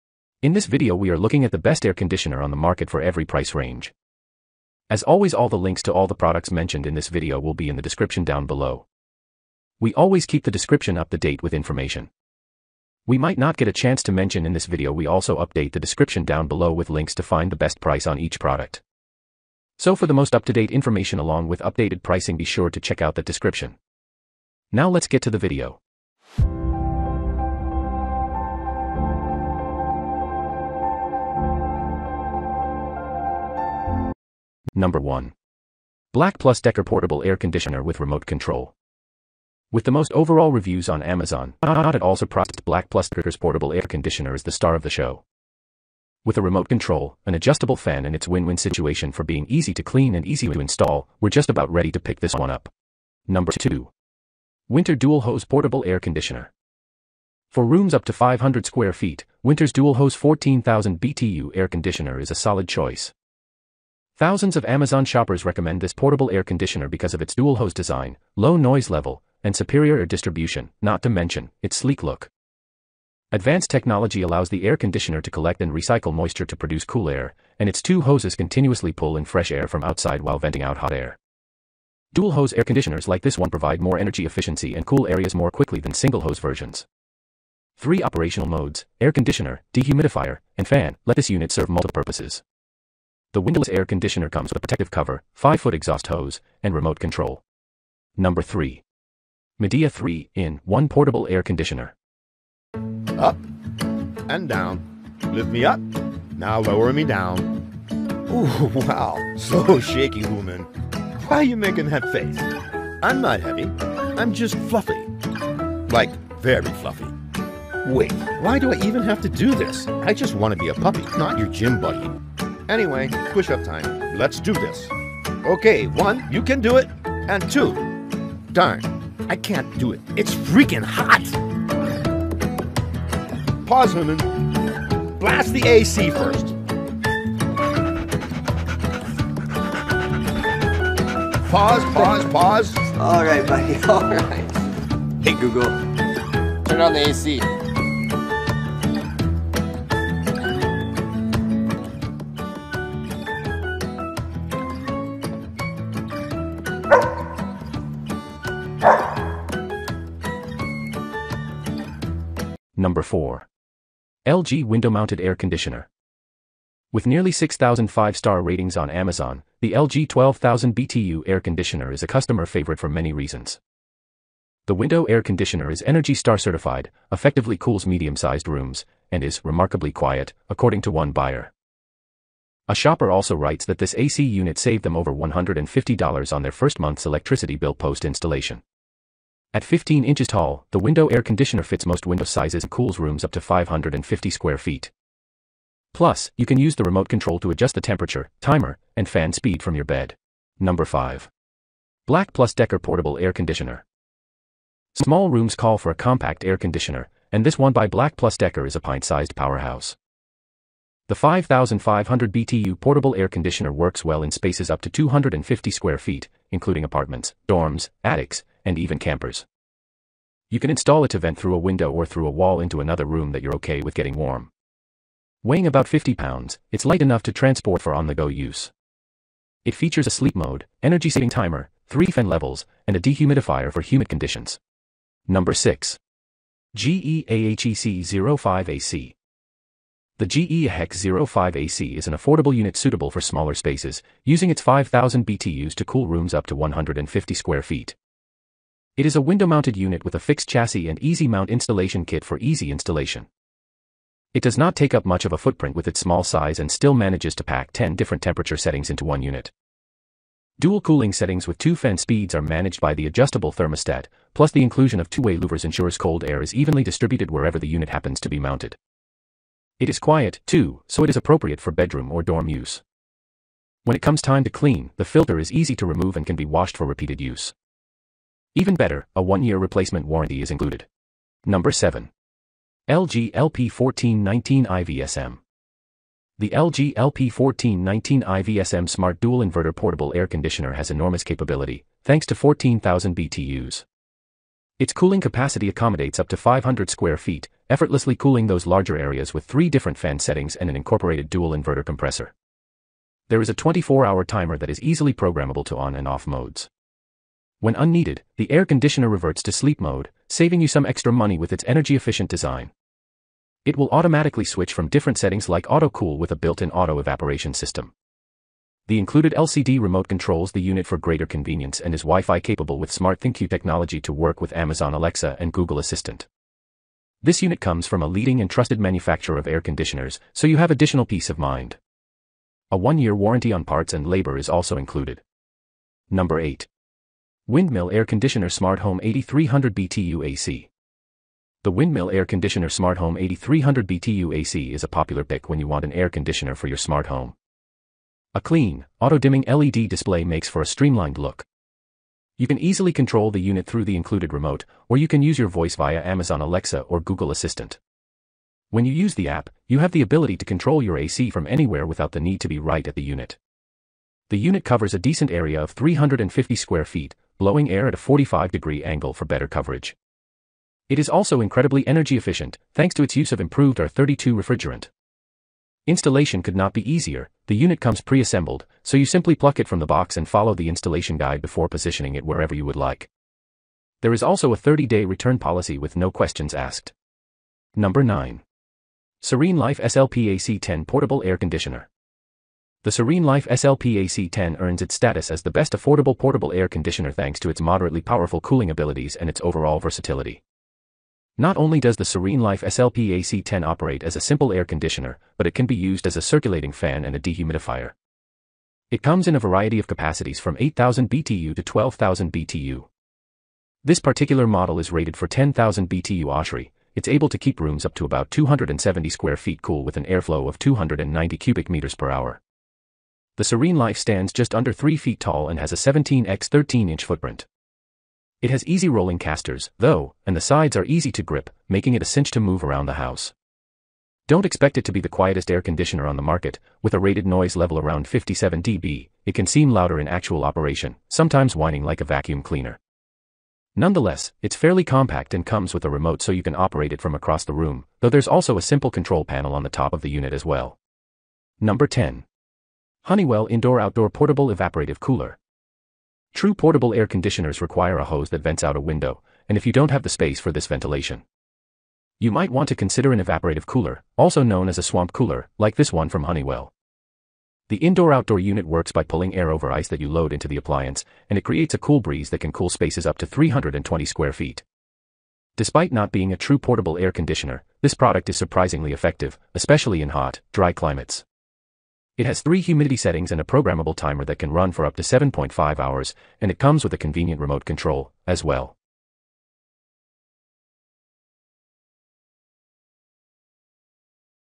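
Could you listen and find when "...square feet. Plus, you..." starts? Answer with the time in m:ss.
3:14.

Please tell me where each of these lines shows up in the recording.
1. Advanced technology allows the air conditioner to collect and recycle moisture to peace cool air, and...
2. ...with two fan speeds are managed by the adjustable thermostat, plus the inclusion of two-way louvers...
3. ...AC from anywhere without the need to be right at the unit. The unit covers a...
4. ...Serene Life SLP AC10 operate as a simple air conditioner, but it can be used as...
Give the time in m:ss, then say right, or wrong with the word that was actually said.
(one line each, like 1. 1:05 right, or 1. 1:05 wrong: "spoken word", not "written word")
1. 1:13 wrong: "produce", not "peace"
2. 4:21 right
3. 6:00 right
4. 6:42 right.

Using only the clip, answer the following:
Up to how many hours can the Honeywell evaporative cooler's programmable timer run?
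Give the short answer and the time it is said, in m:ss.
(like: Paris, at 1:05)
7.5 hours, at 8:05.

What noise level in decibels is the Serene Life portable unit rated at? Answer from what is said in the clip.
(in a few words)
57 dB.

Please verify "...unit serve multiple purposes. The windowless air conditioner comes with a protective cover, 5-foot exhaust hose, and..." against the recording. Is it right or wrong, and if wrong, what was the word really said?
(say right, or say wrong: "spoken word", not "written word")
right.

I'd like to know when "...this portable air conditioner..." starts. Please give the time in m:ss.
1:05.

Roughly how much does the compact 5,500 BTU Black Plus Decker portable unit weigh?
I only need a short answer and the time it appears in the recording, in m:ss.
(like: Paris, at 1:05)
about 50 pounds, at 3:45.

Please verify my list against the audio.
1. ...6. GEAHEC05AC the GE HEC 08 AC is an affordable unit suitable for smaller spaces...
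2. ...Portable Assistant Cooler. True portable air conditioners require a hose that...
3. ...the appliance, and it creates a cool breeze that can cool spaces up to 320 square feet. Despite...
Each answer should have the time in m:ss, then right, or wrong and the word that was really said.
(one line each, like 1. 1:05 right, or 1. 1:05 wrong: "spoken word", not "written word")
1. 3:55 wrong: "05", not "08"
2. 7:34 wrong: "Evaporative", not "Assistant"
3. 7:50 right.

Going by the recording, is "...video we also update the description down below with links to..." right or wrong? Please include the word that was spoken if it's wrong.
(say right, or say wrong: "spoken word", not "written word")
right.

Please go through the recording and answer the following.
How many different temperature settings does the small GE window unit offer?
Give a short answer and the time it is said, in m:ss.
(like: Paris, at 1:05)
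10, at 4:17.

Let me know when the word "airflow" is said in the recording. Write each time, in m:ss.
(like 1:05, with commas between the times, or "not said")
7:00.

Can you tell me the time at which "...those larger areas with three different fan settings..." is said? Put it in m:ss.
4:58.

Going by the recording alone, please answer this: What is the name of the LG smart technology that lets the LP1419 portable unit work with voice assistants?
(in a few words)
SmartThinQ.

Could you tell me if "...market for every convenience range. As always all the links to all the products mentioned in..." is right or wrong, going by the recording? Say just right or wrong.
wrong.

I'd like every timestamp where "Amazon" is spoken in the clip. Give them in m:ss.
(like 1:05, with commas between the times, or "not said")
0:41, 1:04, 2:48, 5:24, 5:56.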